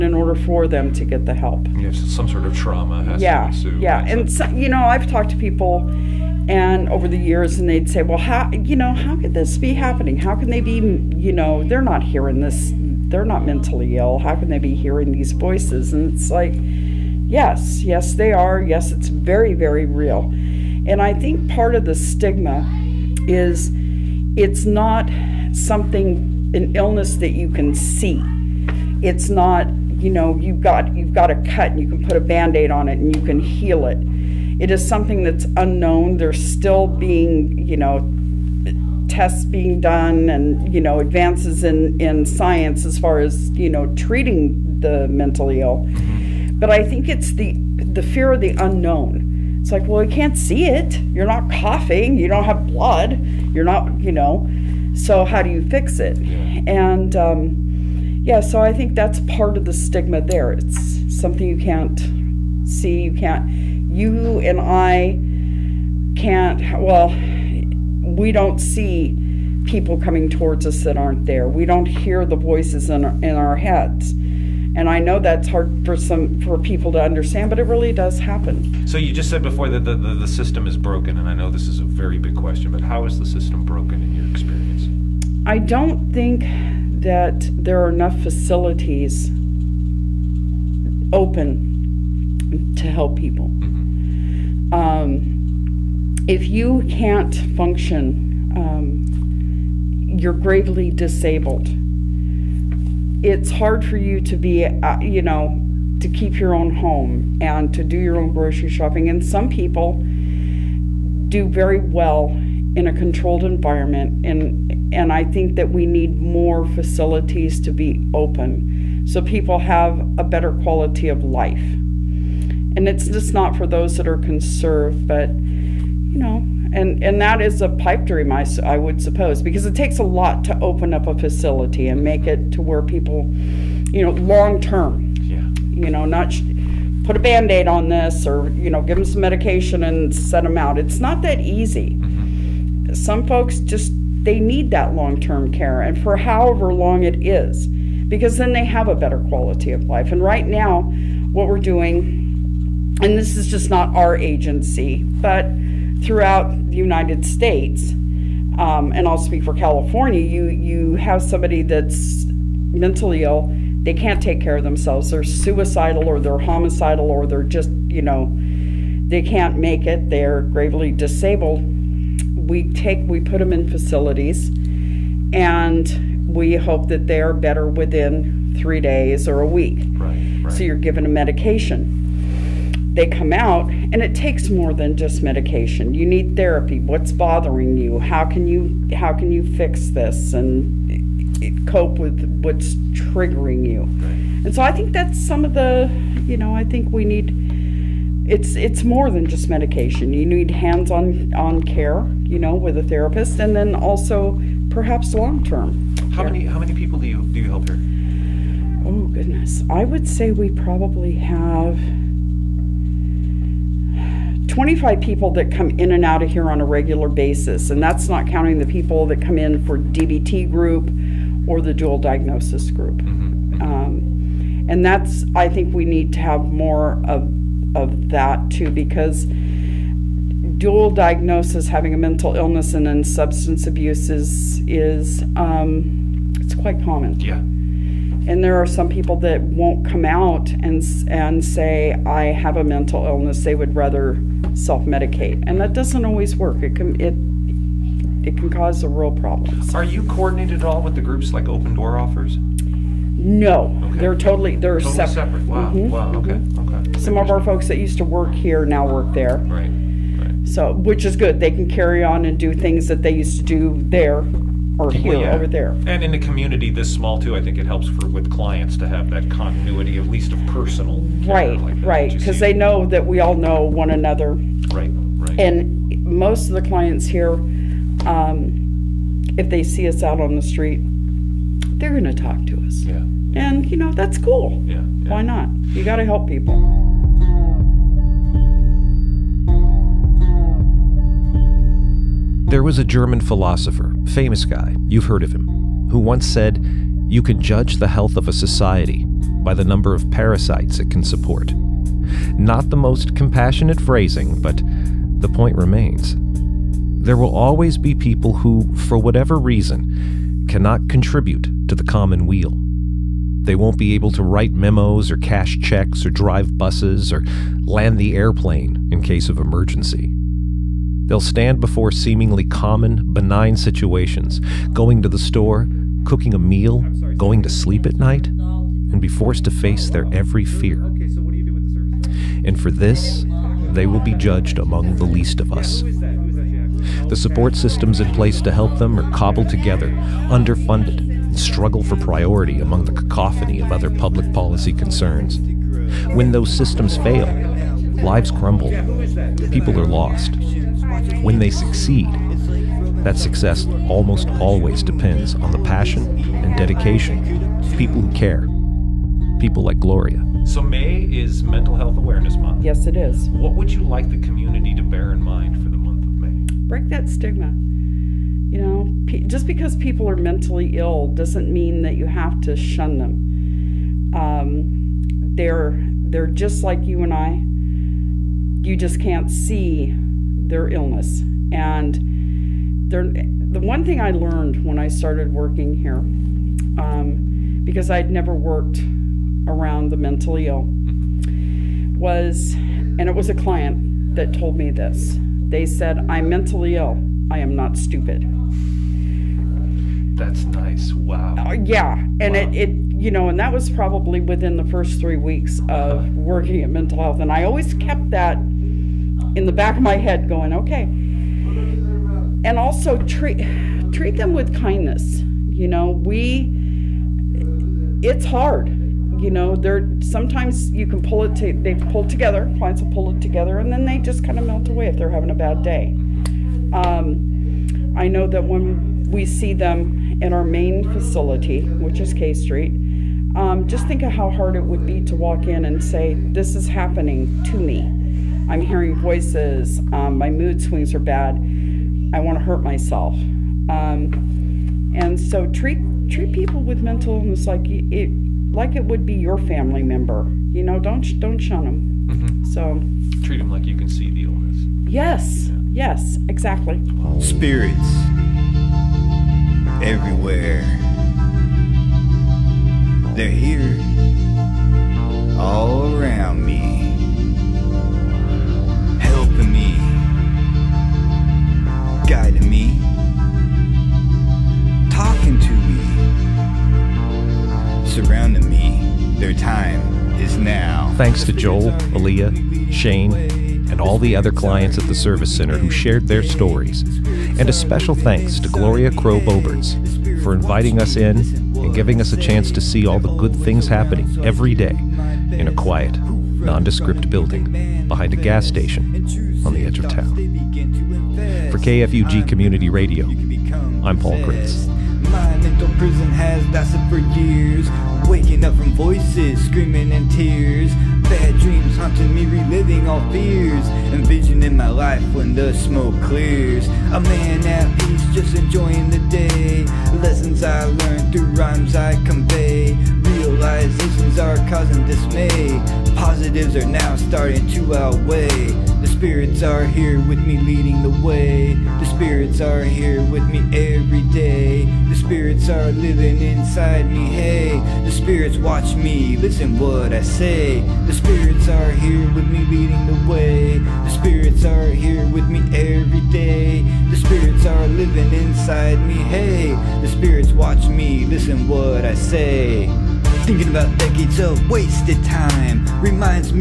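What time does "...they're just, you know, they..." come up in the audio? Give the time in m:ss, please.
2:47.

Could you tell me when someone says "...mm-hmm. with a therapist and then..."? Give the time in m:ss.
3:22.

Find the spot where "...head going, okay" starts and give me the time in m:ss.
6:49.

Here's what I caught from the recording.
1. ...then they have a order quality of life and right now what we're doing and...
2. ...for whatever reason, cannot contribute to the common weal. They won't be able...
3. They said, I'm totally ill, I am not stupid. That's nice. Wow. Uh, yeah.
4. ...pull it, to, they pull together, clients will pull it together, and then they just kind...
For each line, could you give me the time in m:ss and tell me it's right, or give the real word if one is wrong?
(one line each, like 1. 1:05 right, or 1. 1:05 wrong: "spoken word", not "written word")
1. 2:28 wrong: "better", not "order"
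2. 5:08 right
3. 6:35 wrong: "mentally", not "totally"
4. 7:01 right.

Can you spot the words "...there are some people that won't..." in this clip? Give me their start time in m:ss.
3:58.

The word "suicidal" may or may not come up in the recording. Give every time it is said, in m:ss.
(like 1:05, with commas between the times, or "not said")
2:45.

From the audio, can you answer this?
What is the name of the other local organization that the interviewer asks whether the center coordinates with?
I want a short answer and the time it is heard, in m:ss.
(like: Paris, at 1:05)
Open Door, at 4:11.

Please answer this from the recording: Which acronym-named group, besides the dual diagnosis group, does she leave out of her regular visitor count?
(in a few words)
DBT.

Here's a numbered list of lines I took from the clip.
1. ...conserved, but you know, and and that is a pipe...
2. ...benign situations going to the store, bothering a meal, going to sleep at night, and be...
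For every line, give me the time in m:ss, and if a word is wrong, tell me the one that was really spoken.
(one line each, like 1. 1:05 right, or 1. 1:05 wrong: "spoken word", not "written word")
1. 2:04 right
2. 5:23 wrong: "cooking", not "bothering".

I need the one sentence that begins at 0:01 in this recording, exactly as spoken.
Yes, some sort of trauma has yeah, to ensue.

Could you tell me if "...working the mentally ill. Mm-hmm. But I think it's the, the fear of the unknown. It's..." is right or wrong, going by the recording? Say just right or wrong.
wrong.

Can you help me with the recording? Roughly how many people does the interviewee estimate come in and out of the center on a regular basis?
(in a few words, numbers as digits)
25.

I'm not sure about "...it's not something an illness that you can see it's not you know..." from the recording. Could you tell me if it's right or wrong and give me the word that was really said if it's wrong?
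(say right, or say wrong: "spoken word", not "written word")
right.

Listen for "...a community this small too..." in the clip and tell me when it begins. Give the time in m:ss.
4:26.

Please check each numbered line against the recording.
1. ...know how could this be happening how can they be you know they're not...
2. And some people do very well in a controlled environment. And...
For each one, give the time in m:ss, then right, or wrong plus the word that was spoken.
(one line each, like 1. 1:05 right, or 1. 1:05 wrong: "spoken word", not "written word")
1. 0:08 right
2. 1:49 right.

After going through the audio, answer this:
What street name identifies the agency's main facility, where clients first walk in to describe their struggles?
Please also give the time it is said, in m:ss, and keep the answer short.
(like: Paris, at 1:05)
K Street, at 7:12.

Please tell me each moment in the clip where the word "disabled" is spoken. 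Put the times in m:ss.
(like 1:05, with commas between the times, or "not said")
1:40, 2:50.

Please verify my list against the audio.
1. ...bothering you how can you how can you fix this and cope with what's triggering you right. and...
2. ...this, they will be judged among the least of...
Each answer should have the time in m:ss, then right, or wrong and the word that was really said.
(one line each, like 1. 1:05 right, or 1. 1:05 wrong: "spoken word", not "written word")
1. 3:07 right
2. 5:32 right.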